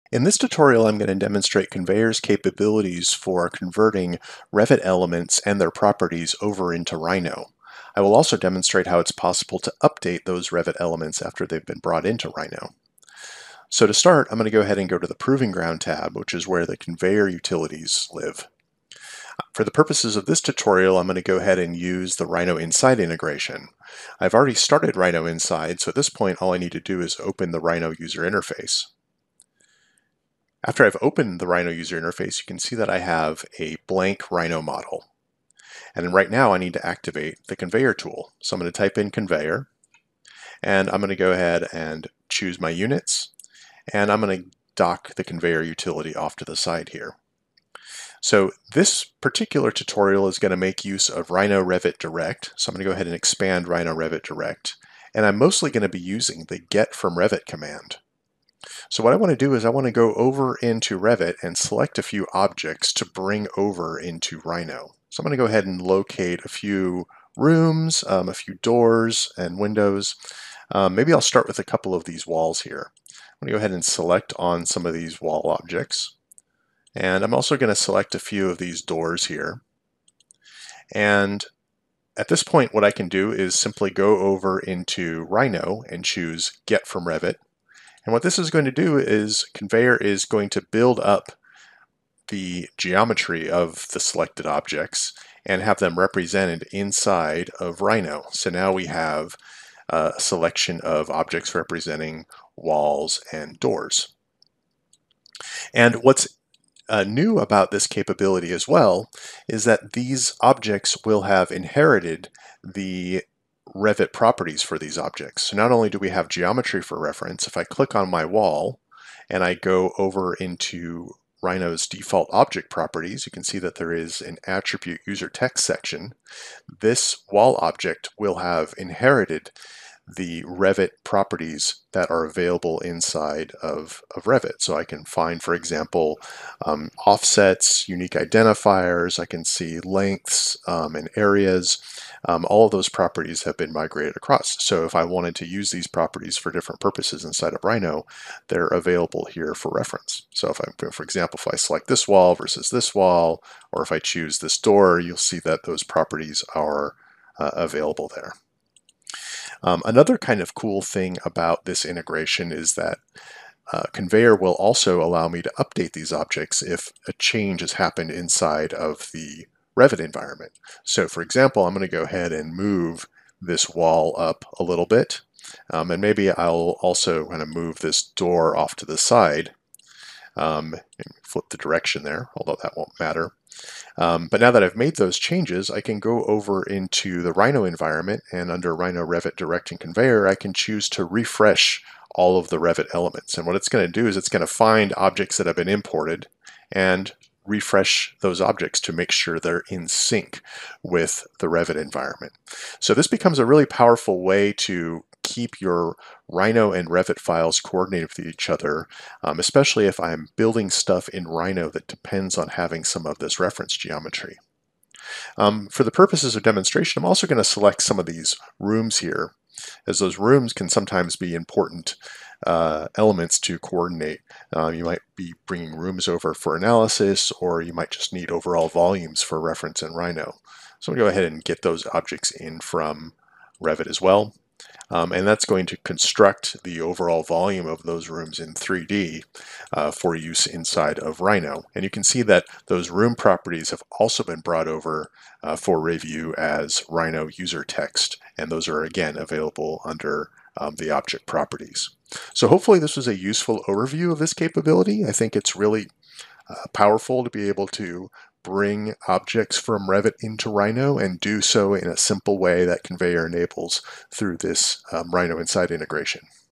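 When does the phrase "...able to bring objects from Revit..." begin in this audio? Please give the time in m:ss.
4:17.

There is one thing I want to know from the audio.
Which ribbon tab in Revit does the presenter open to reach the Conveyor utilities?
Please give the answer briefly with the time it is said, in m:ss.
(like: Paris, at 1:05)
Proving Ground, at 0:15.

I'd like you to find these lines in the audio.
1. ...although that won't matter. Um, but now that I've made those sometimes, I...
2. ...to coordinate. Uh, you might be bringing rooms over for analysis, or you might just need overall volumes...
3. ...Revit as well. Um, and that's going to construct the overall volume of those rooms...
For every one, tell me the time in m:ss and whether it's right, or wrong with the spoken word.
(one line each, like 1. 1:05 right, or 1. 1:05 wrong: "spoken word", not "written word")
1. 3:02 wrong: "changes", not "sometimes"
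2. 3:43 right
3. 3:53 right.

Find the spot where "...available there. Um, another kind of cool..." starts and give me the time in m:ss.
2:37.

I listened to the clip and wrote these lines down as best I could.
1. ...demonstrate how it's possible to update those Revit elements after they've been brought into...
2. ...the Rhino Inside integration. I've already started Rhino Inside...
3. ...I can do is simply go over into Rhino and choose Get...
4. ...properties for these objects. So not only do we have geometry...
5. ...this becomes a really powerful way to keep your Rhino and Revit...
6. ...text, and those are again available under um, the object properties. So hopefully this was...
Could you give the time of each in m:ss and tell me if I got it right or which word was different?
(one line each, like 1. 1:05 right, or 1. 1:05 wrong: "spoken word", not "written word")
1. 0:08 right
2. 0:22 right
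3. 1:22 right
4. 1:54 right
5. 3:22 right
6. 4:07 right.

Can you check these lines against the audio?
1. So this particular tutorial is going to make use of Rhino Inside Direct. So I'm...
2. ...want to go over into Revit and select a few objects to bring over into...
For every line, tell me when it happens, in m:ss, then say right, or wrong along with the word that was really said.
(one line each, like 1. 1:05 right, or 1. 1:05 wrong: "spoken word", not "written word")
1. 0:48 wrong: "Revit", not "Inside"
2. 0:59 right.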